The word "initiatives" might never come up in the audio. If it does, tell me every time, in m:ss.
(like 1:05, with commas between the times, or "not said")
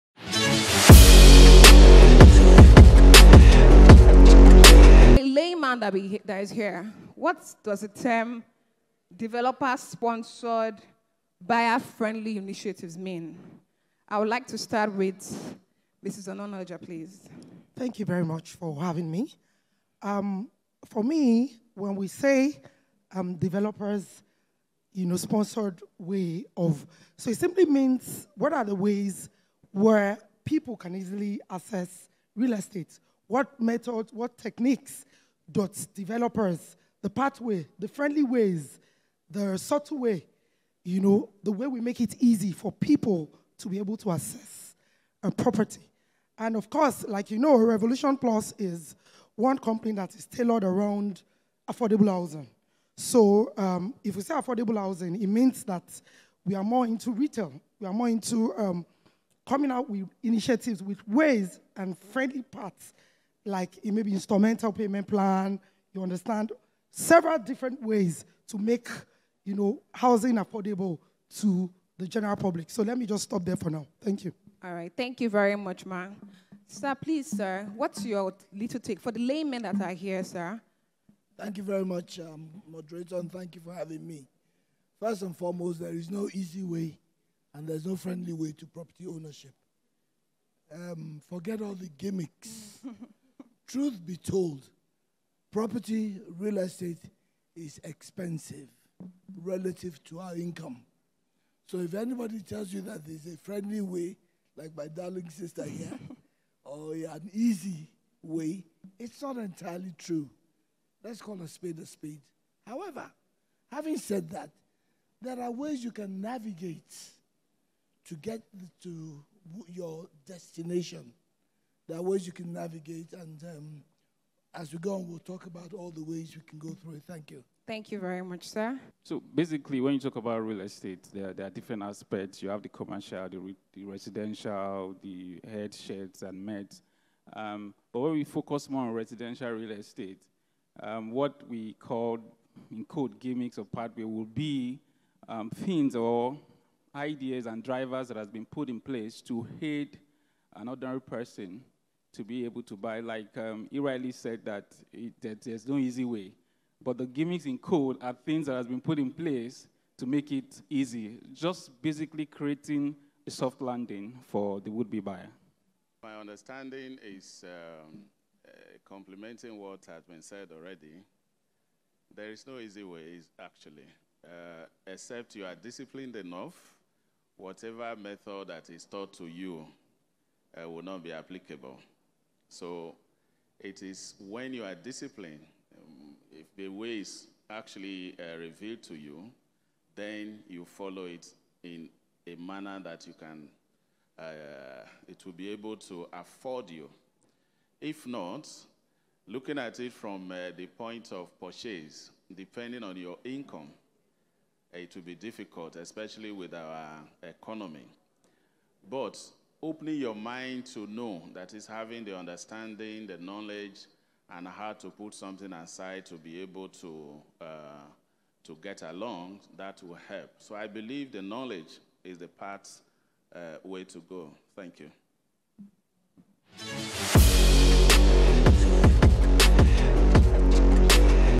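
0:12, 1:00.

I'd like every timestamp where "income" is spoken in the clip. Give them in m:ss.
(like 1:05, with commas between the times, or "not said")
1:40, 3:23.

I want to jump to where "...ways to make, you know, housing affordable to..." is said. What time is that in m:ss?
1:07.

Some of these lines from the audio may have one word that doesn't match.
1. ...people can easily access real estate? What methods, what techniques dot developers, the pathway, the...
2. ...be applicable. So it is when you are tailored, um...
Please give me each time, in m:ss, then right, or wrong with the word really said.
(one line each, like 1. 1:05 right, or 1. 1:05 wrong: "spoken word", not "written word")
1. 0:30 right
2. 3:01 wrong: "disciplined", not "tailored".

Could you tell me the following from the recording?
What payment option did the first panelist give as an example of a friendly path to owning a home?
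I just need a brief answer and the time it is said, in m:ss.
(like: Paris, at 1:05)
instrumental payment plan, at 1:04.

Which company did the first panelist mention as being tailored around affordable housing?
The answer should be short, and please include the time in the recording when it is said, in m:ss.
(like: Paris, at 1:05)
Revolution Plus, at 0:47.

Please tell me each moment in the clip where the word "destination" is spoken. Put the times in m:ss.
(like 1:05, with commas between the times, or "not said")
2:00.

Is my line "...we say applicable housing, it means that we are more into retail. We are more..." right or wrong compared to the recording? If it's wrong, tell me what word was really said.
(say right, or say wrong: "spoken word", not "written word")
wrong: "affordable", not "applicable".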